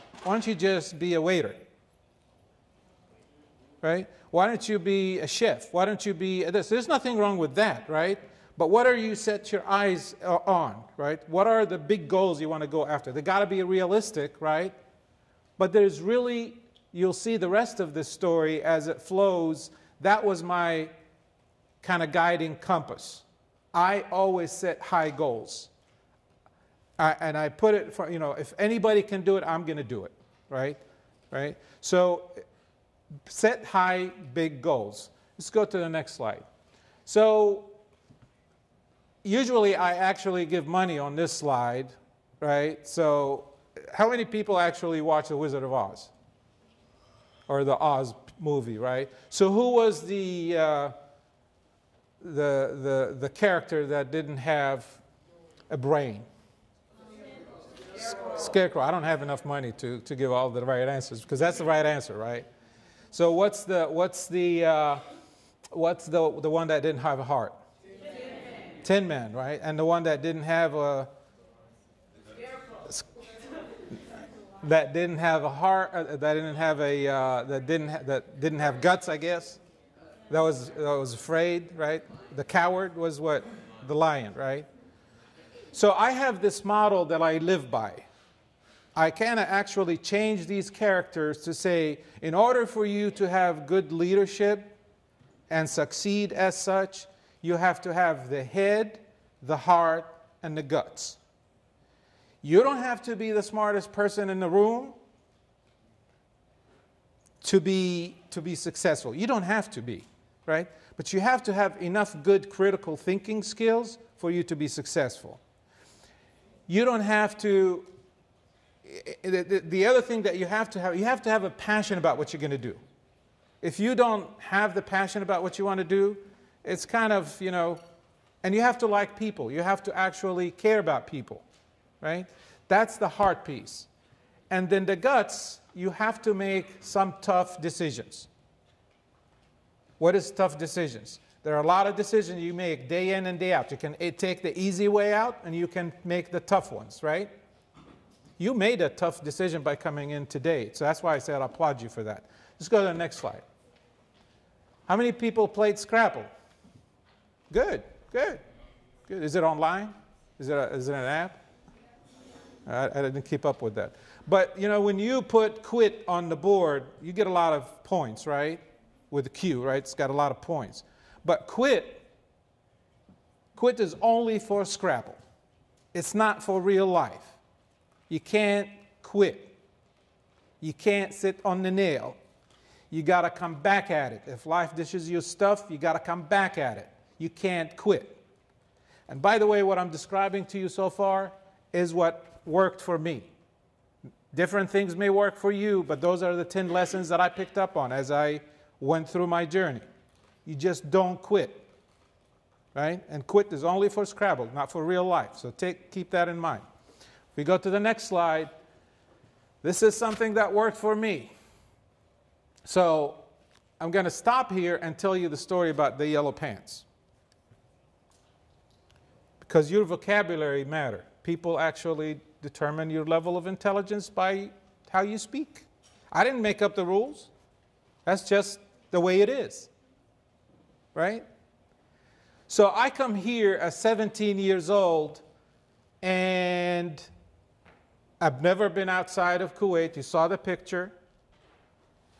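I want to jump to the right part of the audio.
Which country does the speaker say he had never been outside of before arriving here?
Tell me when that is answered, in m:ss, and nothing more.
3:59.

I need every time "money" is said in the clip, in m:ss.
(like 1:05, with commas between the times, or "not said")
0:40, 0:59.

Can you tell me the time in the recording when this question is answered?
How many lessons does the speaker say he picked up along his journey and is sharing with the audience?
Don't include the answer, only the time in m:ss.
3:16.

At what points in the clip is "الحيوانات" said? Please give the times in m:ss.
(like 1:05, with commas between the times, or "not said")
not said.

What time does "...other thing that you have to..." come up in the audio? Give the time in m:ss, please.
1:59.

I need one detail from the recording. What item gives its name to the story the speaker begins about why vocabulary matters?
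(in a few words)
Yellow pants.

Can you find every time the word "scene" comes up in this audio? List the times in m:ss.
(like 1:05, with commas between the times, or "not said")
not said.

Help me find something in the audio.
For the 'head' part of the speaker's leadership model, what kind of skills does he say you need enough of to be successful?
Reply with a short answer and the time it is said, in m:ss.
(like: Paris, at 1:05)
Critical thinking skills, at 1:52.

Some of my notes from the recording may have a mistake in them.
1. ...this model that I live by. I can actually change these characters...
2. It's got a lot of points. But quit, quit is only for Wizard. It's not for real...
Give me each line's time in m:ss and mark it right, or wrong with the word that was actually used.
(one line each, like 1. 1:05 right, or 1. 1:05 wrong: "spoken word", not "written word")
1. 1:26 right
2. 2:49 wrong: "Scrabble", not "Wizard".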